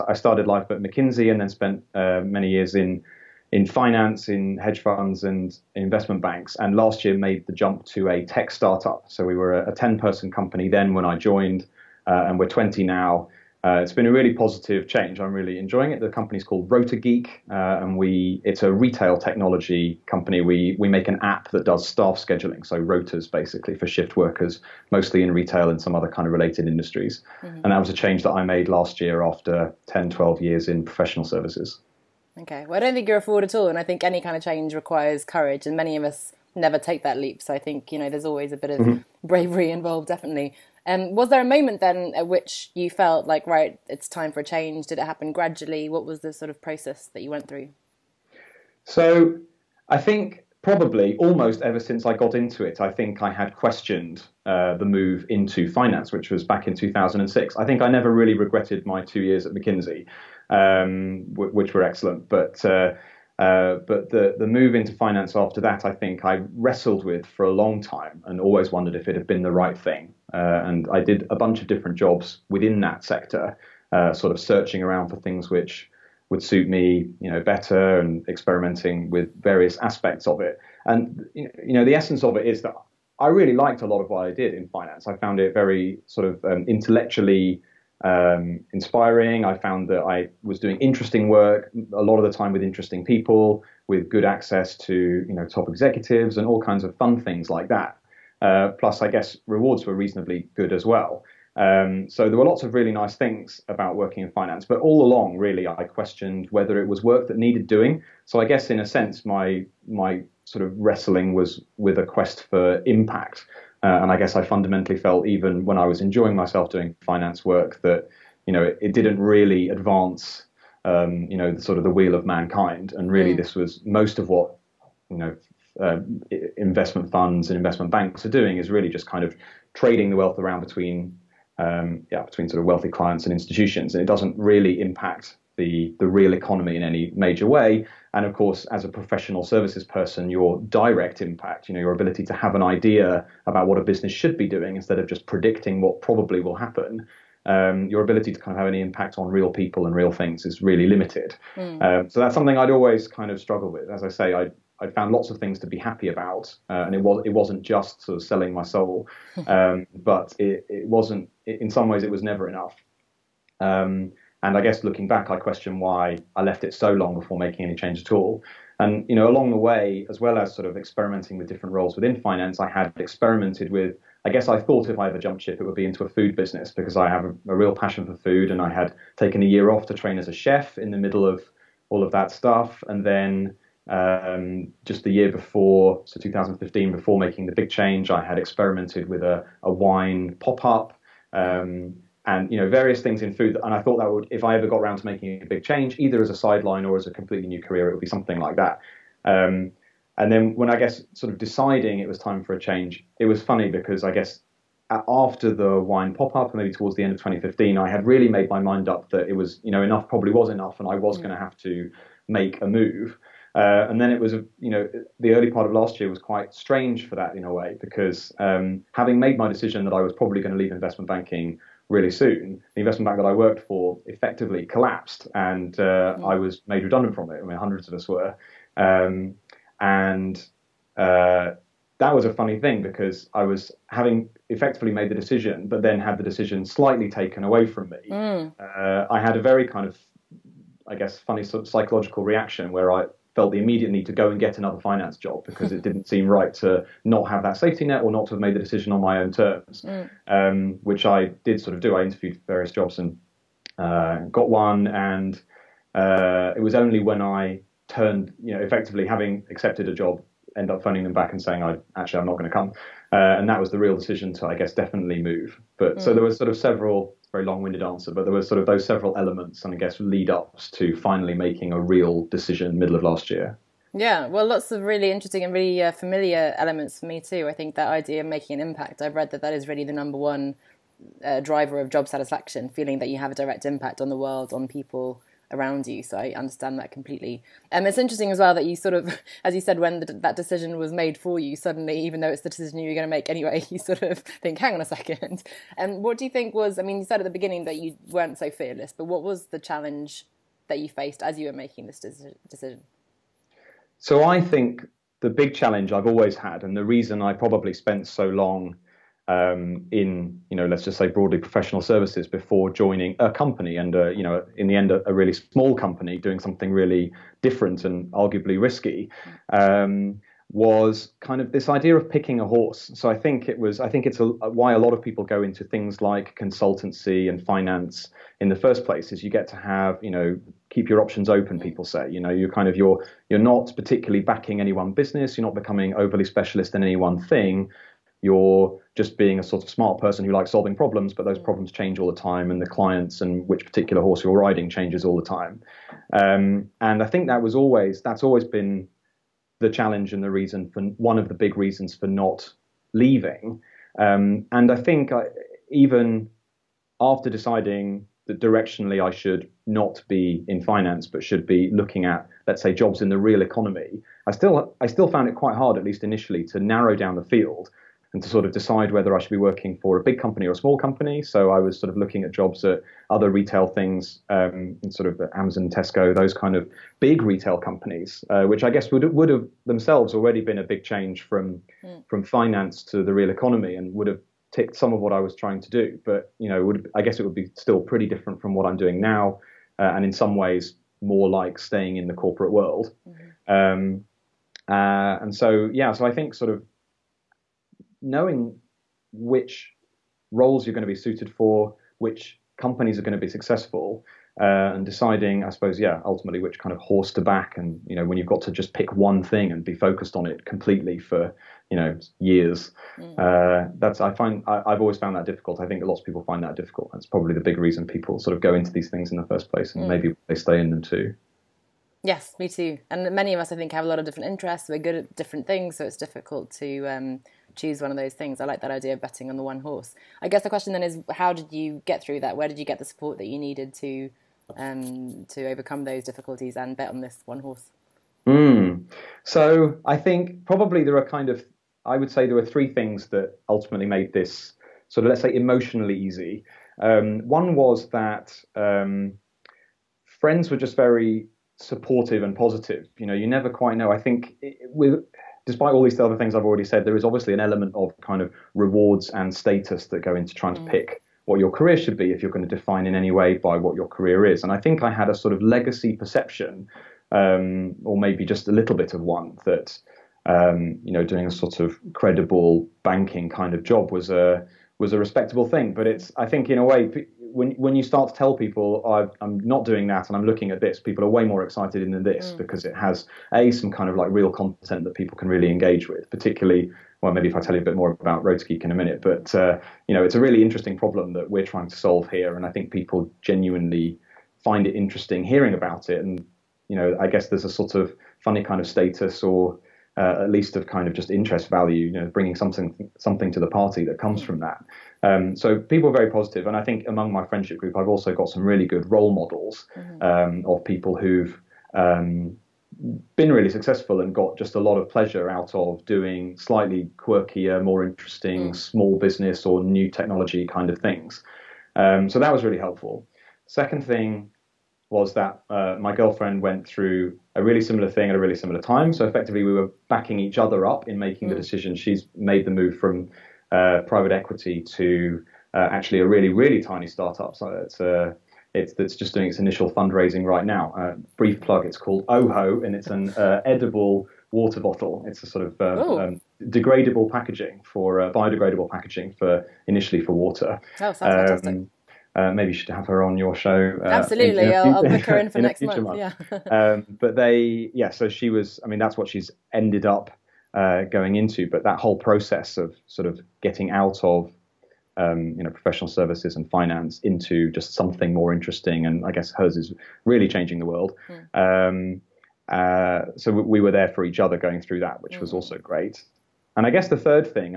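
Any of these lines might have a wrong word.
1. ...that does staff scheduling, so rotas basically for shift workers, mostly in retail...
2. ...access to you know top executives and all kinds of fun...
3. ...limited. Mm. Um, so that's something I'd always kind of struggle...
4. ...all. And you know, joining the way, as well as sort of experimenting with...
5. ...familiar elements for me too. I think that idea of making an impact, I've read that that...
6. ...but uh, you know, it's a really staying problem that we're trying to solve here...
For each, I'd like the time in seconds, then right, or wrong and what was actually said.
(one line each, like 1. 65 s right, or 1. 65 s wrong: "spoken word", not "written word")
1. 21 s right
2. 94 s right
3. 150 s right
4. 168 s wrong: "along", not "joining"
5. 275 s right
6. 489 s wrong: "interesting", not "staying".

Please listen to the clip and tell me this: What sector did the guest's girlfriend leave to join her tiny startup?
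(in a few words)
private equity.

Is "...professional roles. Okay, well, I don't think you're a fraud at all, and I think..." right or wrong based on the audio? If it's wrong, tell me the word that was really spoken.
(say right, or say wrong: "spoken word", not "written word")
wrong: "services", not "roles".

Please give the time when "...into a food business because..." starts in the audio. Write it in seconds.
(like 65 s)
175 s.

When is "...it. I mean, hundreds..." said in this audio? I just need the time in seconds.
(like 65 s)
227 s.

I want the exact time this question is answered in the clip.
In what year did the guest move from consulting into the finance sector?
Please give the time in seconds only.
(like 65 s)
56 s.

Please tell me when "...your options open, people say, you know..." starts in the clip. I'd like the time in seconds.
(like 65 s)
330 s.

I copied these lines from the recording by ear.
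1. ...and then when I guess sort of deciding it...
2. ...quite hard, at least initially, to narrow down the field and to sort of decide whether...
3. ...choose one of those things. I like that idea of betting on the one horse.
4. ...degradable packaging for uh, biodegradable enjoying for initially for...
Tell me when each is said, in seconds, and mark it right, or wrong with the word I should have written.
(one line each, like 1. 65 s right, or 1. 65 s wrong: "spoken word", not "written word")
1. 200 s right
2. 365 s right
3. 427 s right
4. 546 s wrong: "packaging", not "enjoying".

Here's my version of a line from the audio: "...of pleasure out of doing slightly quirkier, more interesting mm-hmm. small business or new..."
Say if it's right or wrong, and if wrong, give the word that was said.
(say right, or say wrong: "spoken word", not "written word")
right.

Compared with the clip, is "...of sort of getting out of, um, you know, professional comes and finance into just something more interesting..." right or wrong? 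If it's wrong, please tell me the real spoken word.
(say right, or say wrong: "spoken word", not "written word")
wrong: "services", not "comes".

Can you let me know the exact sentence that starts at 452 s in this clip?
You know, you never quite know.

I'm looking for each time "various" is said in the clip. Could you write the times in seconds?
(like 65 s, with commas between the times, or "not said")
79 s, 192 s, 252 s.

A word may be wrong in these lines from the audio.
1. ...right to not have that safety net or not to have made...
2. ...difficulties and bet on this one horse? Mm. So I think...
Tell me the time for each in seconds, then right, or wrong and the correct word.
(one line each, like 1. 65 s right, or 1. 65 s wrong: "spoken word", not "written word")
1. 246 s right
2. 436 s right.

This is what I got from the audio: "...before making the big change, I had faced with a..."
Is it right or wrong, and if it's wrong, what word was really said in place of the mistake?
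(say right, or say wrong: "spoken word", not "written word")
wrong: "experimented", not "faced".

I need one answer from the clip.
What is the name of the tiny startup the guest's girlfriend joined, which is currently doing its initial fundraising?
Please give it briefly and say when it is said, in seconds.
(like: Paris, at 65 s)
Ooho, at 542 s.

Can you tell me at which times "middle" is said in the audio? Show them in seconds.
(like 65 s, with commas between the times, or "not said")
180 s, 272 s.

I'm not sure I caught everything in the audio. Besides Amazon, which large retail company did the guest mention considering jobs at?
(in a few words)
Tesco.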